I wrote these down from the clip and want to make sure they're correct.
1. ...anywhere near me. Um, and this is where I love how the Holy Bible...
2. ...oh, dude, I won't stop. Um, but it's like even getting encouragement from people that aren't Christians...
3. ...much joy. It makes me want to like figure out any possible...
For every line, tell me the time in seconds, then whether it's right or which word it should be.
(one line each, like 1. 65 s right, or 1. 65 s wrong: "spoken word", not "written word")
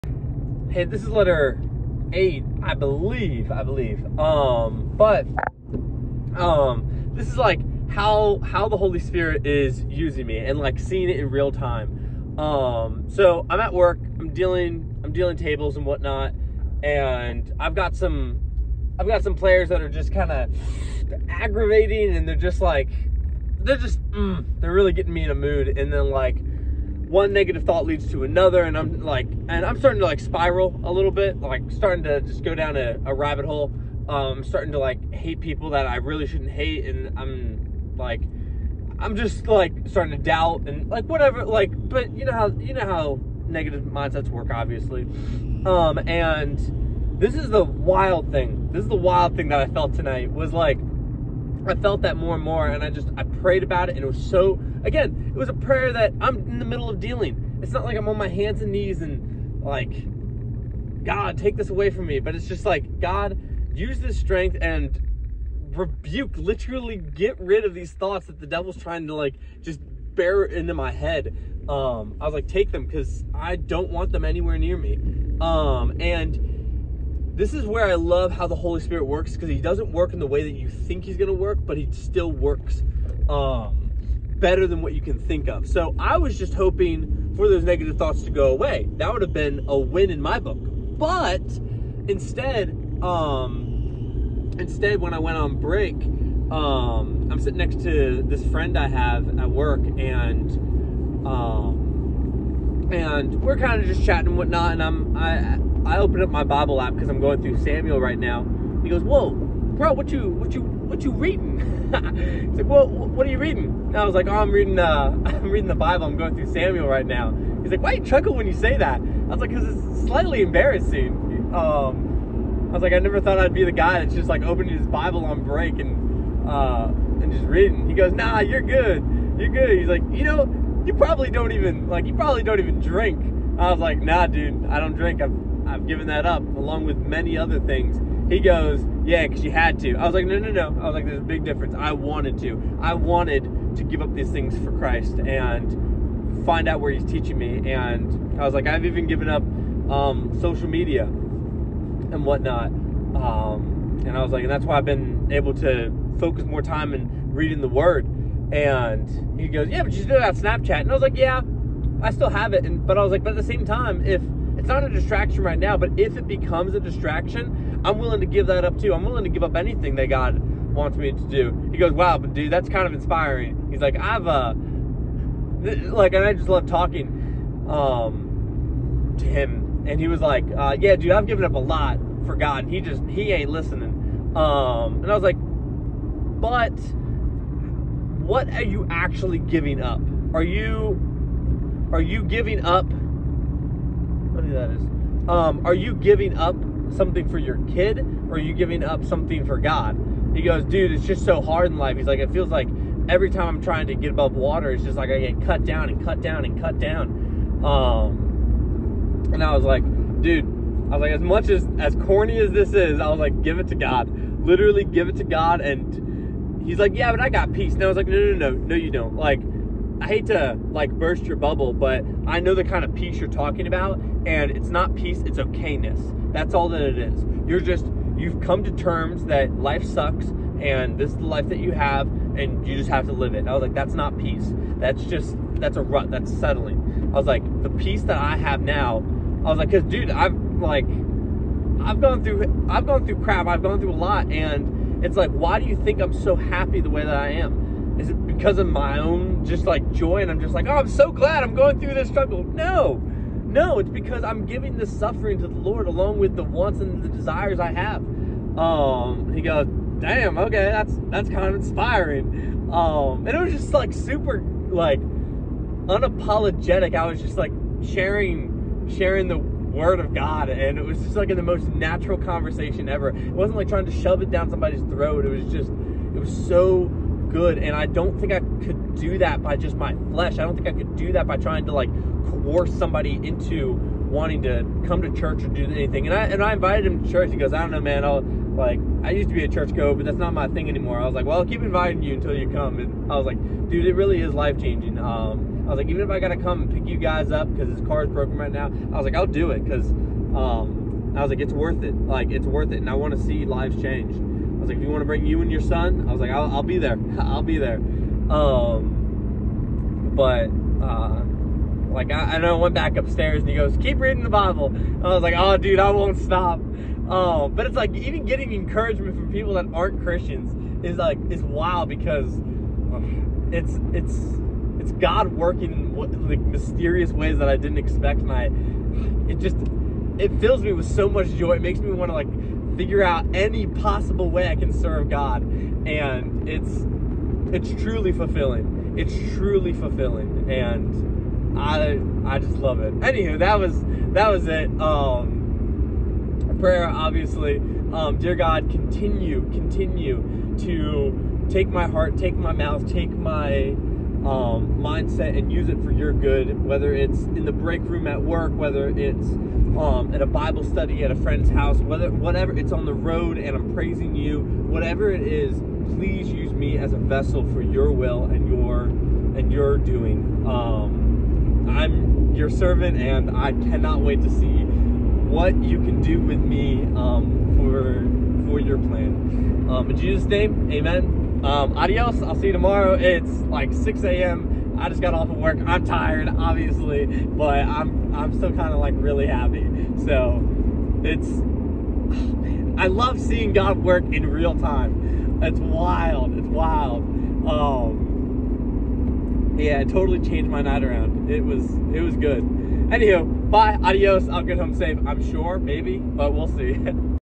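1. 74 s wrong: "Spirit", not "Bible"
2. 315 s right
3. 331 s right.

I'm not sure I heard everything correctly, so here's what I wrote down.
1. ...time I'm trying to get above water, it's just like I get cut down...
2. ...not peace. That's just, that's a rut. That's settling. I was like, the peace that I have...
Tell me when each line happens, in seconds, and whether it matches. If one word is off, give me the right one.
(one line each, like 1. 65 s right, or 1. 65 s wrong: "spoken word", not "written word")
1. 203 s right
2. 233 s right.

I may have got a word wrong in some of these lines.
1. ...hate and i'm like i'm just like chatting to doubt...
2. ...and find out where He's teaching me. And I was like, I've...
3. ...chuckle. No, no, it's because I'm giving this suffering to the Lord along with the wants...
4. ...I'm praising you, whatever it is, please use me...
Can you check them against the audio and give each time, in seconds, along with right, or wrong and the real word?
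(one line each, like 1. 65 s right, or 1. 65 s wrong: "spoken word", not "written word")
1. 36 s wrong: "starting", not "chatting"
2. 145 s right
3. 252 s wrong: "struggle", not "chuckle"
4. 363 s right.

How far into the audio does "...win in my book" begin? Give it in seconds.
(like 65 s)
89 s.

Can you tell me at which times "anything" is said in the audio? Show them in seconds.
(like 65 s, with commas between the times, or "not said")
169 s, 285 s.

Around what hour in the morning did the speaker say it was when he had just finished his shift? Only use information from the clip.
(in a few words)
6 a.m.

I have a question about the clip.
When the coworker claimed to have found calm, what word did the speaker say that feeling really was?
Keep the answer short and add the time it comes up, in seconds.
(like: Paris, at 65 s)
Okayness, at 225 s.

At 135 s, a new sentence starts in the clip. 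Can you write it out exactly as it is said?
I've I've given that up, along with many other things.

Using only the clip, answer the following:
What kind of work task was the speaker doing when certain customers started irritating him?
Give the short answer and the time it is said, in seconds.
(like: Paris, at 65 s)
Dealing tables, at 15 s.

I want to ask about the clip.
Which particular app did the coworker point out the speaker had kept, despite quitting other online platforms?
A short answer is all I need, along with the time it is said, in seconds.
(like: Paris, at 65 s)
Snapchat, at 160 s.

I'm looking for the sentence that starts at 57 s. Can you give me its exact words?
It's not like I'm on my hands and knees and like, God, take this away from me.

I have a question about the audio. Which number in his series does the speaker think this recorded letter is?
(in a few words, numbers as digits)
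8.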